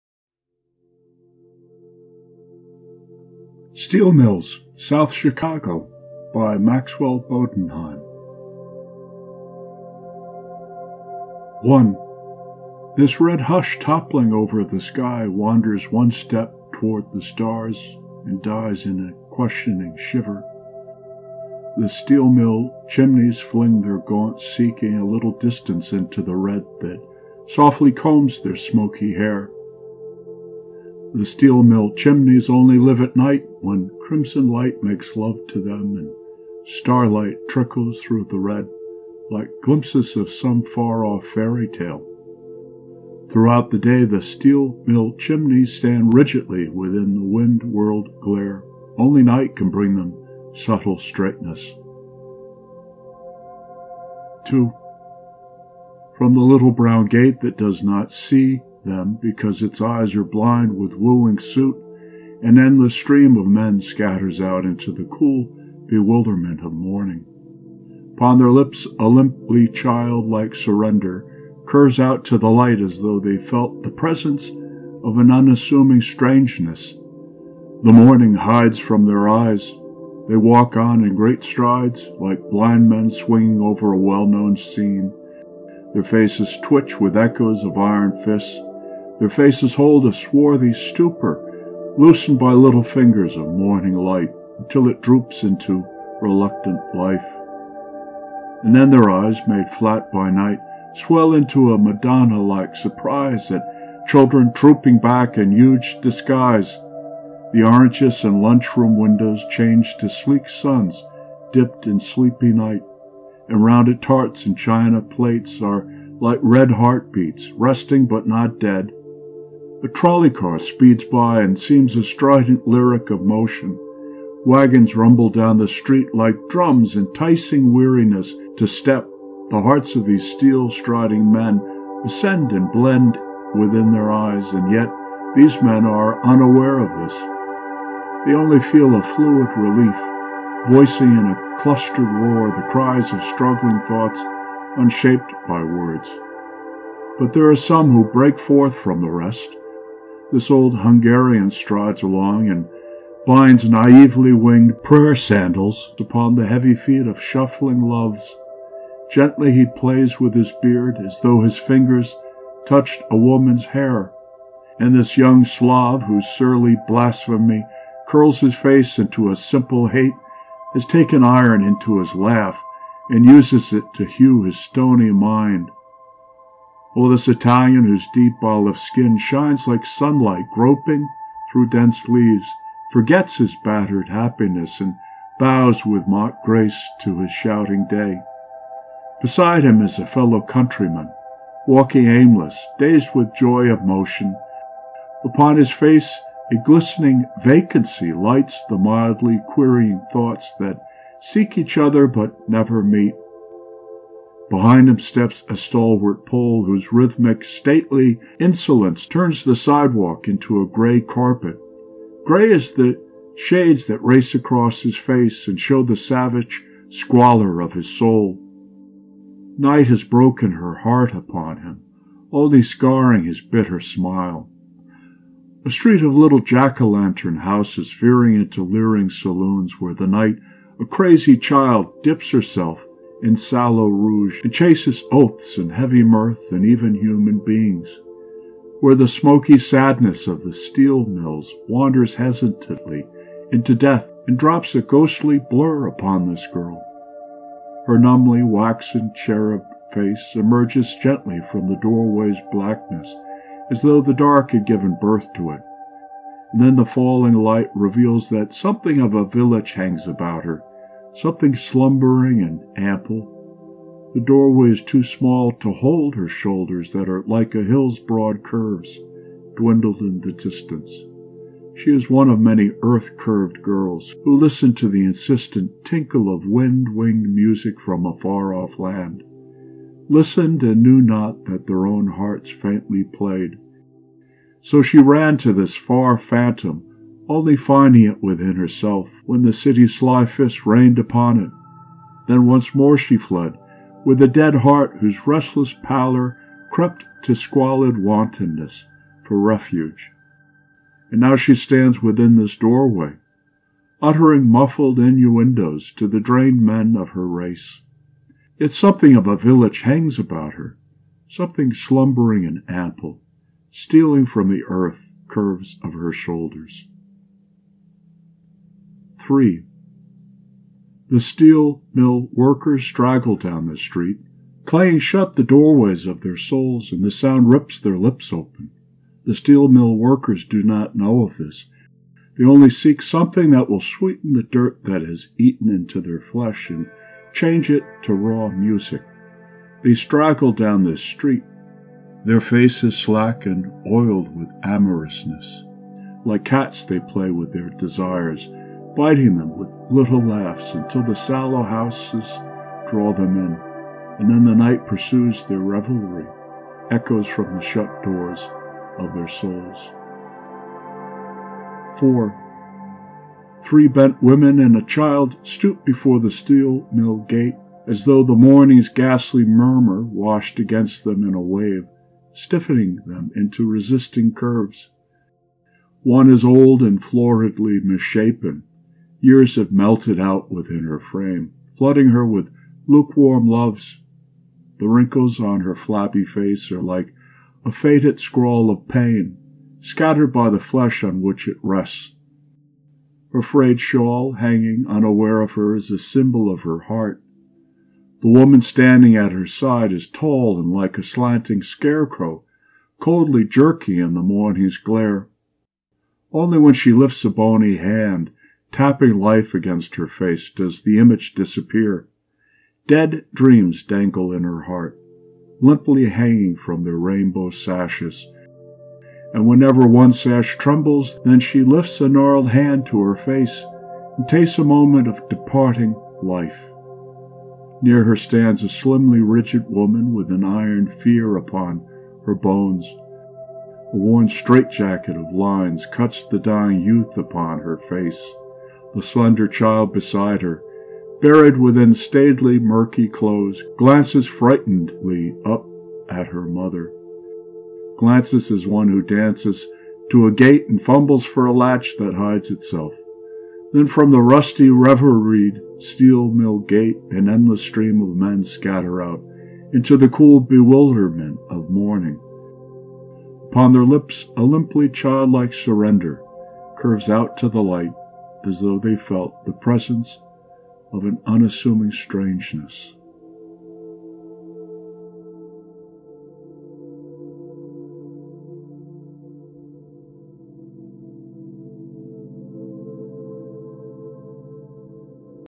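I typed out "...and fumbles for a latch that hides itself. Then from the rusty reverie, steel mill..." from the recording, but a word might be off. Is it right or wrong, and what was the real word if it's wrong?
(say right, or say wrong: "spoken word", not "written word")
right.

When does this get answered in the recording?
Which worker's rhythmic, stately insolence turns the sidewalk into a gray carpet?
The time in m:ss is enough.
3:26.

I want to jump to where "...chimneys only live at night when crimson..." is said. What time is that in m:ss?
0:31.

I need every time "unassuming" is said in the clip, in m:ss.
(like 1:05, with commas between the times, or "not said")
1:15, 7:51.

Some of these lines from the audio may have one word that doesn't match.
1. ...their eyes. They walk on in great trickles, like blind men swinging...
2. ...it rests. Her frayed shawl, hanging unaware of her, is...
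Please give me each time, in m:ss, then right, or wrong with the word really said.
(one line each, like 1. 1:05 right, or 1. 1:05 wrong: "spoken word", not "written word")
1. 1:19 wrong: "strides", not "trickles"
2. 6:31 right.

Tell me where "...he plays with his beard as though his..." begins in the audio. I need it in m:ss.
2:39.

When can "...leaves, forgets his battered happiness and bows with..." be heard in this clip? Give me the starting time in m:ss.
3:02.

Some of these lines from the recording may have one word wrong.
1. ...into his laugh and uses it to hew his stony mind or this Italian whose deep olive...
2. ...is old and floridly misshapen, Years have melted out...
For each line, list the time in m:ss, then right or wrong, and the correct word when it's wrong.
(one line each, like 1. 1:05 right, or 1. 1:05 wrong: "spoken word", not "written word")
1. 2:51 right
2. 6:16 right.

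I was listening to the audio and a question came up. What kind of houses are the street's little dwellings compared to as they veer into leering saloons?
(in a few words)
jack-o'-lantern houses.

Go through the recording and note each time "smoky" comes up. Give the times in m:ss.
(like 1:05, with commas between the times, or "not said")
0:28, 3:59.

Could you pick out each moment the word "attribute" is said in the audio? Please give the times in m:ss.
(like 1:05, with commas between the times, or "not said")
not said.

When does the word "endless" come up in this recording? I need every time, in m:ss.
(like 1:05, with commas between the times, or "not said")
1:02, 7:37.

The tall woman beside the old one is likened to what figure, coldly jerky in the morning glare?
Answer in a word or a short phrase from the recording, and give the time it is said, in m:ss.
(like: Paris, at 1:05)
slanting scarecrow, at 6:41.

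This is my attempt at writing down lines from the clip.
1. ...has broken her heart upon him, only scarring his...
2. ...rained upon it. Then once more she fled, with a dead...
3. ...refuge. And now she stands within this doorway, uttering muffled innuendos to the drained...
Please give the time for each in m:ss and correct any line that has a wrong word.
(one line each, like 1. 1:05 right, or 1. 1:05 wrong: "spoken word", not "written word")
1. 3:39 right
2. 4:50 right
3. 4:59 right.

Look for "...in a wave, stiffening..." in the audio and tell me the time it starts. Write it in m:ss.
6:11.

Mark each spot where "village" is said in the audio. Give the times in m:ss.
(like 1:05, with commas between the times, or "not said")
4:19, 5:09.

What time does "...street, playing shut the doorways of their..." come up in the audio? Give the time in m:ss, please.
5:23.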